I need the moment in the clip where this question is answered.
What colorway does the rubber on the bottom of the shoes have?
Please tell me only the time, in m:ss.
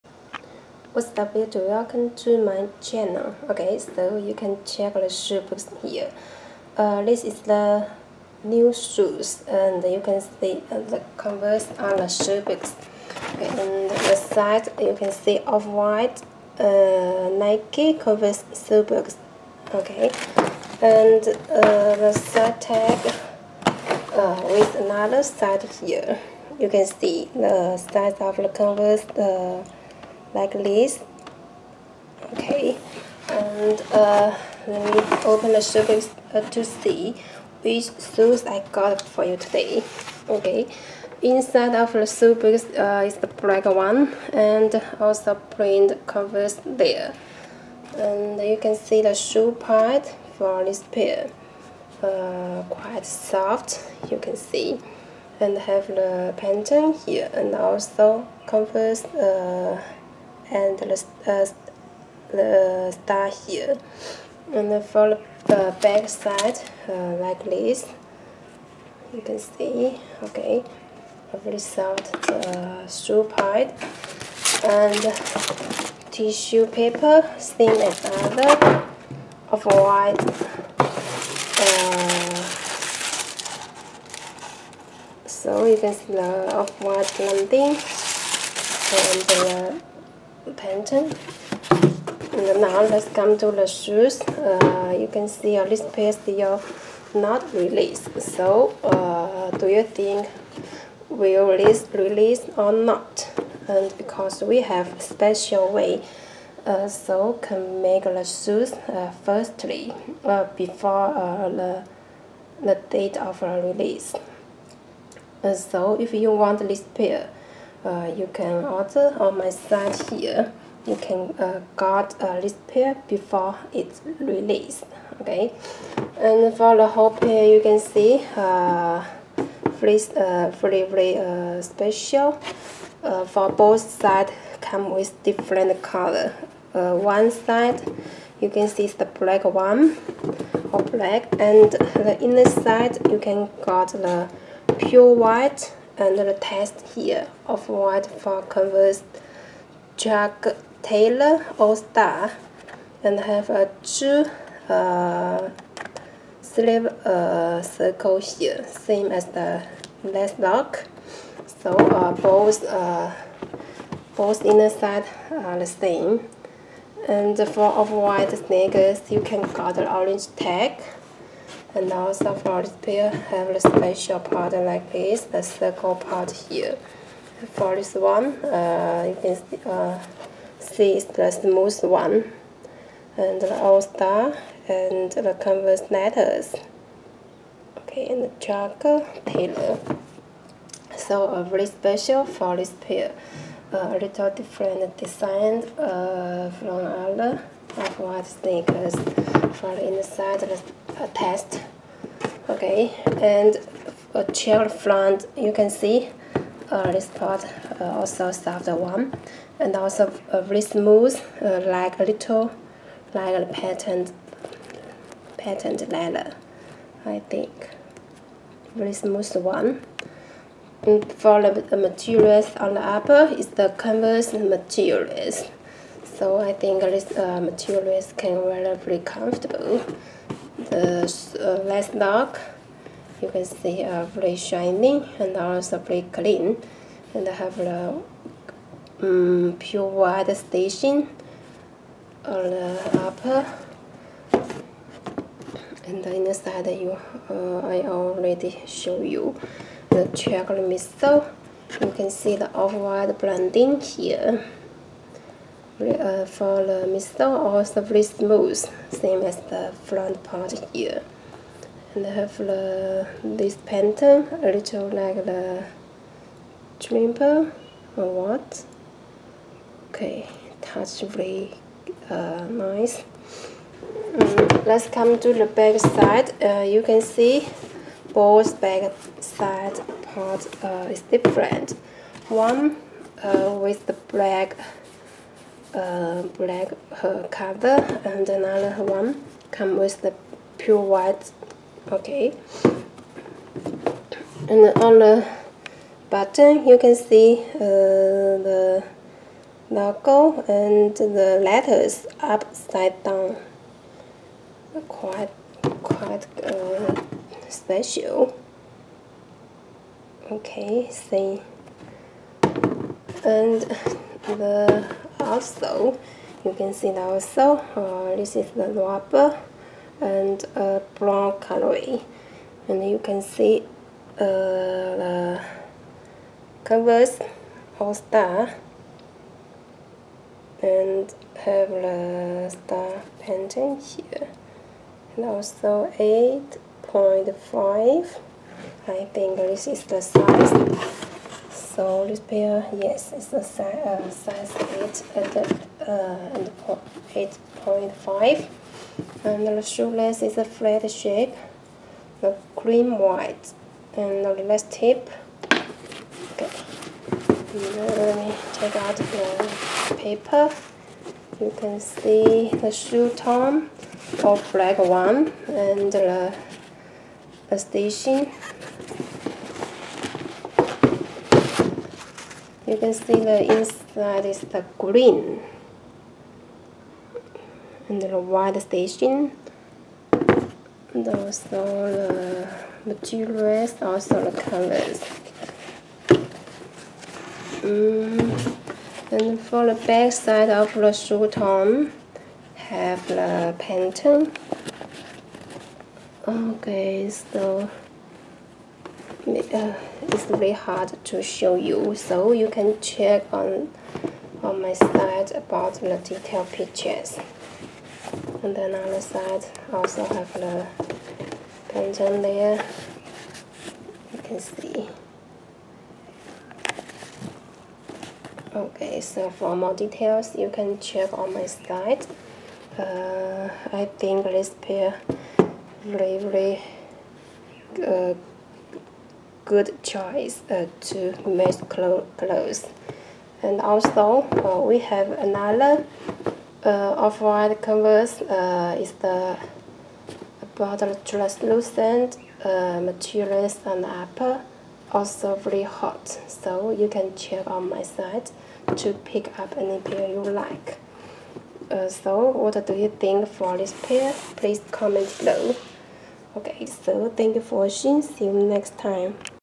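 5:20.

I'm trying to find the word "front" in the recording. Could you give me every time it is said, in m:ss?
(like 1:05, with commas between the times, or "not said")
3:24, 4:19.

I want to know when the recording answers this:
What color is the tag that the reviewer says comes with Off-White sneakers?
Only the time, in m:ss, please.
2:49.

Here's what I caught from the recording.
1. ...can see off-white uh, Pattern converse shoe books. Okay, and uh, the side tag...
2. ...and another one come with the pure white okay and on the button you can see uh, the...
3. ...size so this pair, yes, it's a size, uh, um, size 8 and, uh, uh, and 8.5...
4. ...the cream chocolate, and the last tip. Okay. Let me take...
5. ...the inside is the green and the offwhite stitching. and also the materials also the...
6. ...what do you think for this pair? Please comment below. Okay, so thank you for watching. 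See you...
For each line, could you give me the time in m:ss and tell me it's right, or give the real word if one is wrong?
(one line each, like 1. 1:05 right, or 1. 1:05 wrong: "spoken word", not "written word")
1. 0:14 wrong: "Nike", not "Pattern"
2. 4:48 right
3. 5:40 right
4. 5:52 wrong: "white", not "chocolate"
5. 6:13 wrong: "white", not "offwhite"
6. 7:32 right.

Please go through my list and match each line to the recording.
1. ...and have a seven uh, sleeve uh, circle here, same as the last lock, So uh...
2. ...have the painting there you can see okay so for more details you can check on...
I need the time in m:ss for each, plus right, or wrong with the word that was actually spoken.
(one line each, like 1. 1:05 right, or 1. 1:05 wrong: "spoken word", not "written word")
1. 2:33 wrong: "two", not "seven"
2. 6:50 right.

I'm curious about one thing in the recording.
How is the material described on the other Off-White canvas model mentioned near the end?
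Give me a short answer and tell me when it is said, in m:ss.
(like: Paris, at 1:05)
Translucent, at 7:21.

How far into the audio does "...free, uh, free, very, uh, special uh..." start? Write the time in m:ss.
2:09.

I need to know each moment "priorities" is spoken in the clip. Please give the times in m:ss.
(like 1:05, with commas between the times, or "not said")
not said.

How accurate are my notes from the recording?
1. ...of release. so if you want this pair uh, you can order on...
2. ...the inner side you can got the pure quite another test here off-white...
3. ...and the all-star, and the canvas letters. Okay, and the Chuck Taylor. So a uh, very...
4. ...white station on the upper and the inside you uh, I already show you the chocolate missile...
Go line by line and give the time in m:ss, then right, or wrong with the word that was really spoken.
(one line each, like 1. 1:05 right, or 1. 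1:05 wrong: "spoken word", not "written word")
1. 1:53 right
2. 2:21 wrong: "white", not "quite"
3. 3:03 right
4. 3:59 right.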